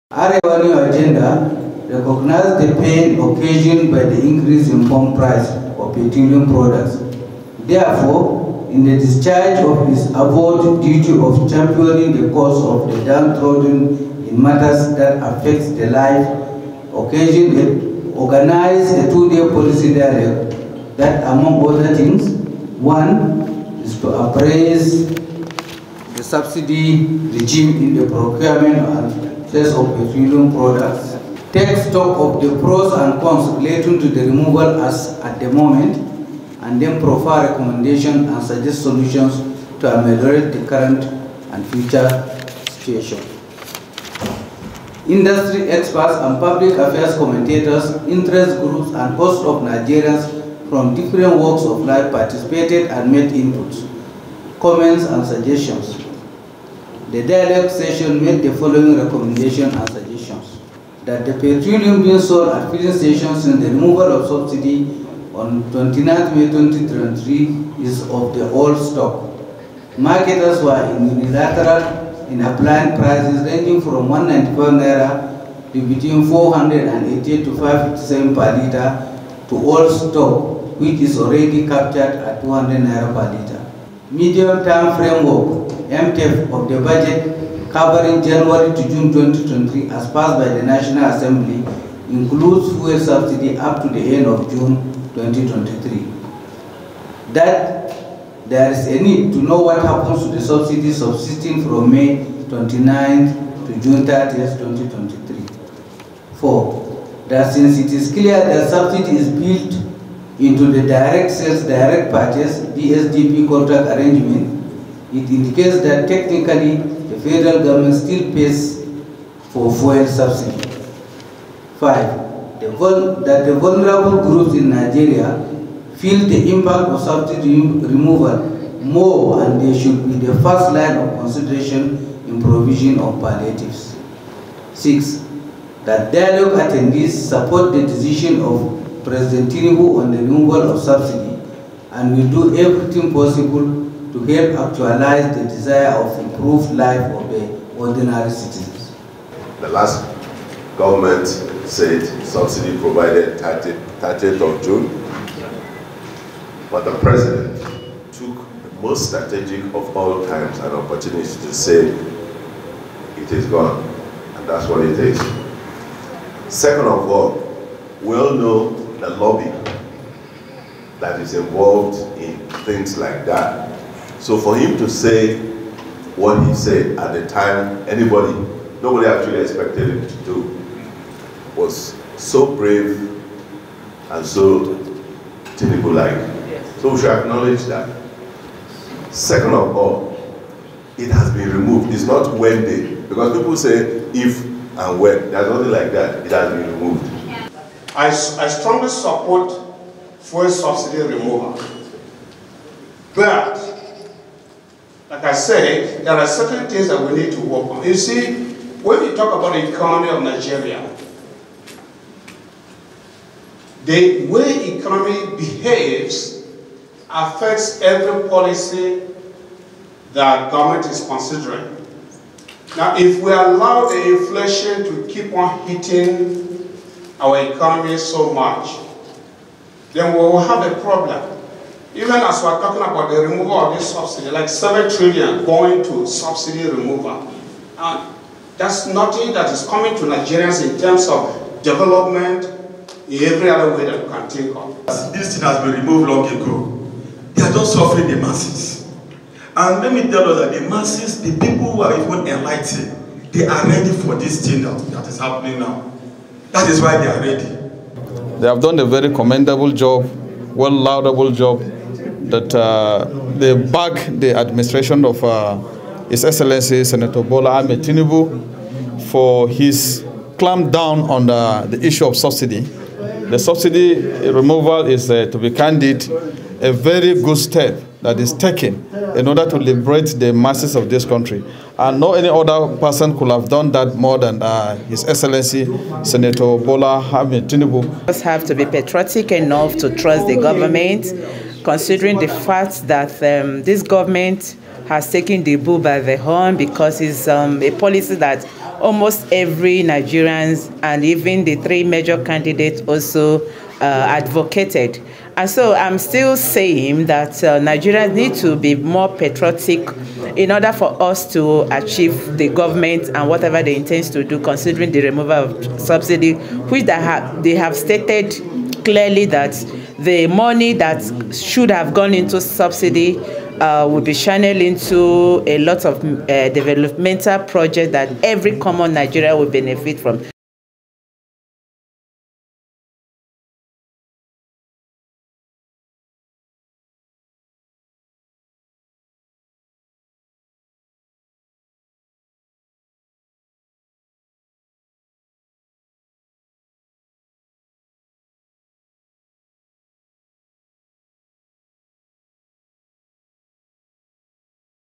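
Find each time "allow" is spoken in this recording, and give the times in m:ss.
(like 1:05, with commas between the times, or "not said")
3:43.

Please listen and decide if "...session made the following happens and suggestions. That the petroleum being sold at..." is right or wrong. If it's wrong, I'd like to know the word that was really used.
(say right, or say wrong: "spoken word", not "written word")
wrong: "recommendations", not "happens".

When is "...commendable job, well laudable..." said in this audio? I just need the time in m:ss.
4:19.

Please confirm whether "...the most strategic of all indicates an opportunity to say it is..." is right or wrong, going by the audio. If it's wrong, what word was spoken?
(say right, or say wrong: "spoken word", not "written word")
wrong: "times", not "indicates".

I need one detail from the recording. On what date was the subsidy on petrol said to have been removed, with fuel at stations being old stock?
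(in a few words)
29 May 2023.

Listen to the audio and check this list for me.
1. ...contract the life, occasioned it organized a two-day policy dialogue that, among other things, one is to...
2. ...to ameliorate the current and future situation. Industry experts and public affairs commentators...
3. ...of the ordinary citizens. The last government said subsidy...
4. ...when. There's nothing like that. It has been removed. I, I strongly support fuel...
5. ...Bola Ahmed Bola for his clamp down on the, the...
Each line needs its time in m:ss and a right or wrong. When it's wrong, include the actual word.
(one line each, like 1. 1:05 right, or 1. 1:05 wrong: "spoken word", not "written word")
1. 0:15 wrong: "affect", not "contract"
2. 0:39 right
3. 2:26 right
4. 3:14 right
5. 4:27 wrong: "Tinubu", not "Bola".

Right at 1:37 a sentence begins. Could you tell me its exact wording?
That there is a need to know what happens to the subsidy subsisting from May 29th to June 30th, 2023.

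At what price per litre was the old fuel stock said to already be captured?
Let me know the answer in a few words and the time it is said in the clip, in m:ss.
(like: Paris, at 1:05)
200 naira, at 1:22.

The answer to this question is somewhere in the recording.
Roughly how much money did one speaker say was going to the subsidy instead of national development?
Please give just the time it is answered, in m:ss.
3:54.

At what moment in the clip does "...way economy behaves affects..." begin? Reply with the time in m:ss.
3:34.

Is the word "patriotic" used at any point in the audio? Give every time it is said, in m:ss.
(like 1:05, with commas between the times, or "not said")
4:48, 5:09.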